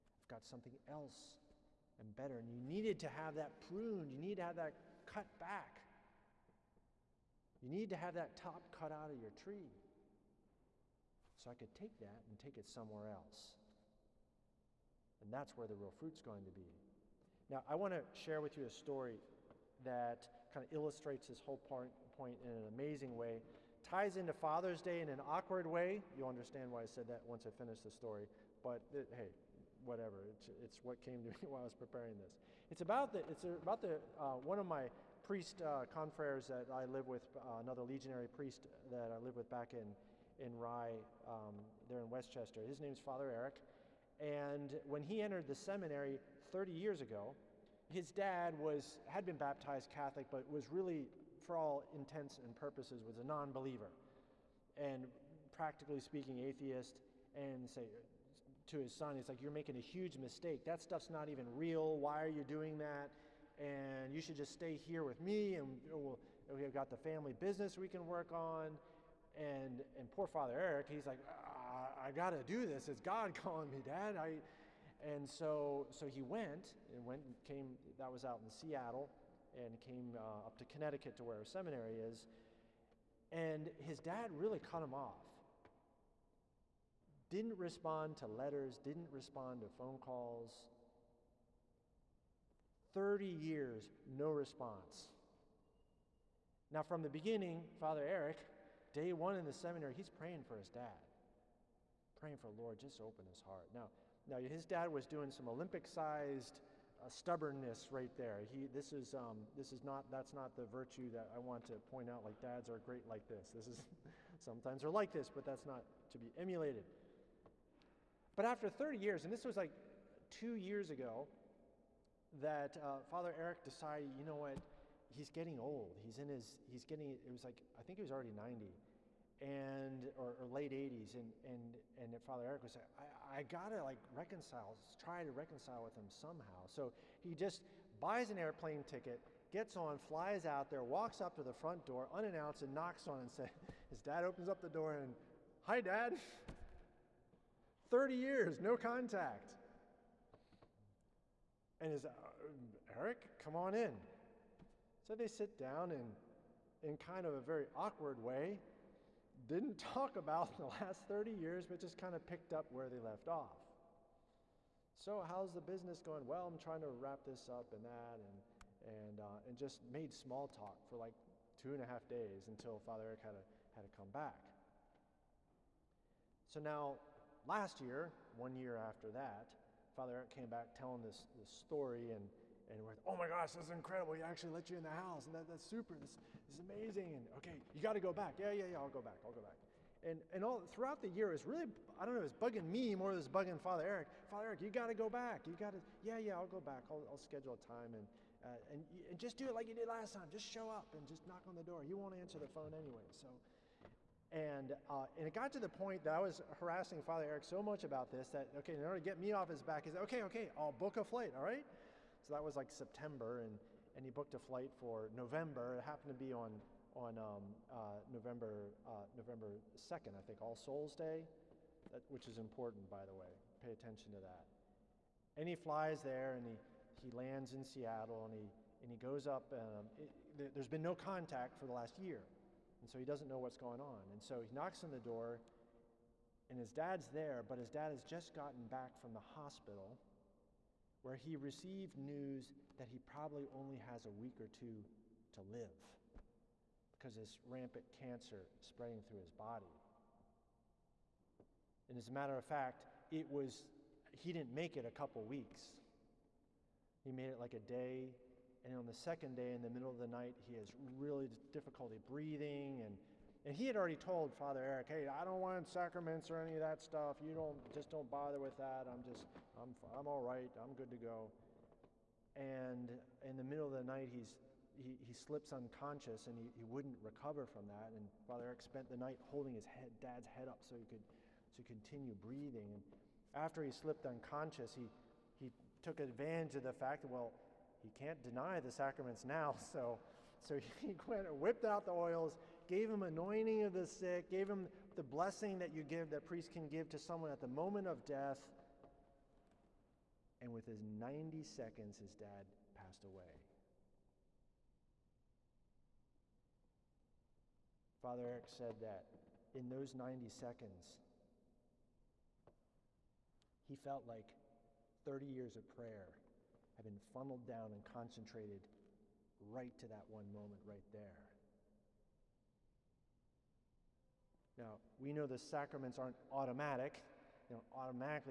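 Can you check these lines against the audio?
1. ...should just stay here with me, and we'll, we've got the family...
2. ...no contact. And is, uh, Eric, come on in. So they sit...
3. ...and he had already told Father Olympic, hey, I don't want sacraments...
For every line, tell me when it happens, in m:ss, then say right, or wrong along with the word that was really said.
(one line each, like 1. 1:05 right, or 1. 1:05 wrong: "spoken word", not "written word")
1. 1:04 right
2. 2:28 right
3. 4:23 wrong: "Eric", not "Olympic".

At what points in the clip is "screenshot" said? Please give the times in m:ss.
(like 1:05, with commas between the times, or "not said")
not said.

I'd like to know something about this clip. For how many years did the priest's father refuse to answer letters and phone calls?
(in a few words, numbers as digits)
30.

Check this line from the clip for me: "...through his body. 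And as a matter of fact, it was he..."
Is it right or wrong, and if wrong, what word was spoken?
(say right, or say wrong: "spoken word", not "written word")
right.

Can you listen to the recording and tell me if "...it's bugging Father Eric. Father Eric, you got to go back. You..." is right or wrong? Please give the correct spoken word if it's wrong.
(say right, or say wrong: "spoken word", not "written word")
right.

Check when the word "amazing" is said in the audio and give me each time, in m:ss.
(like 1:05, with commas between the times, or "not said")
0:22, 3:06.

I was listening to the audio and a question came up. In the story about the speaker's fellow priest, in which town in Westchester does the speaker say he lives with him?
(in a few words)
Rye.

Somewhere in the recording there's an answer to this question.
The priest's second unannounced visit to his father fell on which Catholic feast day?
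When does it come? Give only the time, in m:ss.
3:40.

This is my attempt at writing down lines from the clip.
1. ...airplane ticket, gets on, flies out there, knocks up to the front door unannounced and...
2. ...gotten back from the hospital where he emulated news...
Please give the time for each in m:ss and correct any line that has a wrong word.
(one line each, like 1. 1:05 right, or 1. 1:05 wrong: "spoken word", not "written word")
1. 2:18 wrong: "walks", not "knocks"
2. 3:58 wrong: "received", not "emulated".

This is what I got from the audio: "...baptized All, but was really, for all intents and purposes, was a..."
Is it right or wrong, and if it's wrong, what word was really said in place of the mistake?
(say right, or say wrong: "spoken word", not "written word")
wrong: "Catholic", not "All".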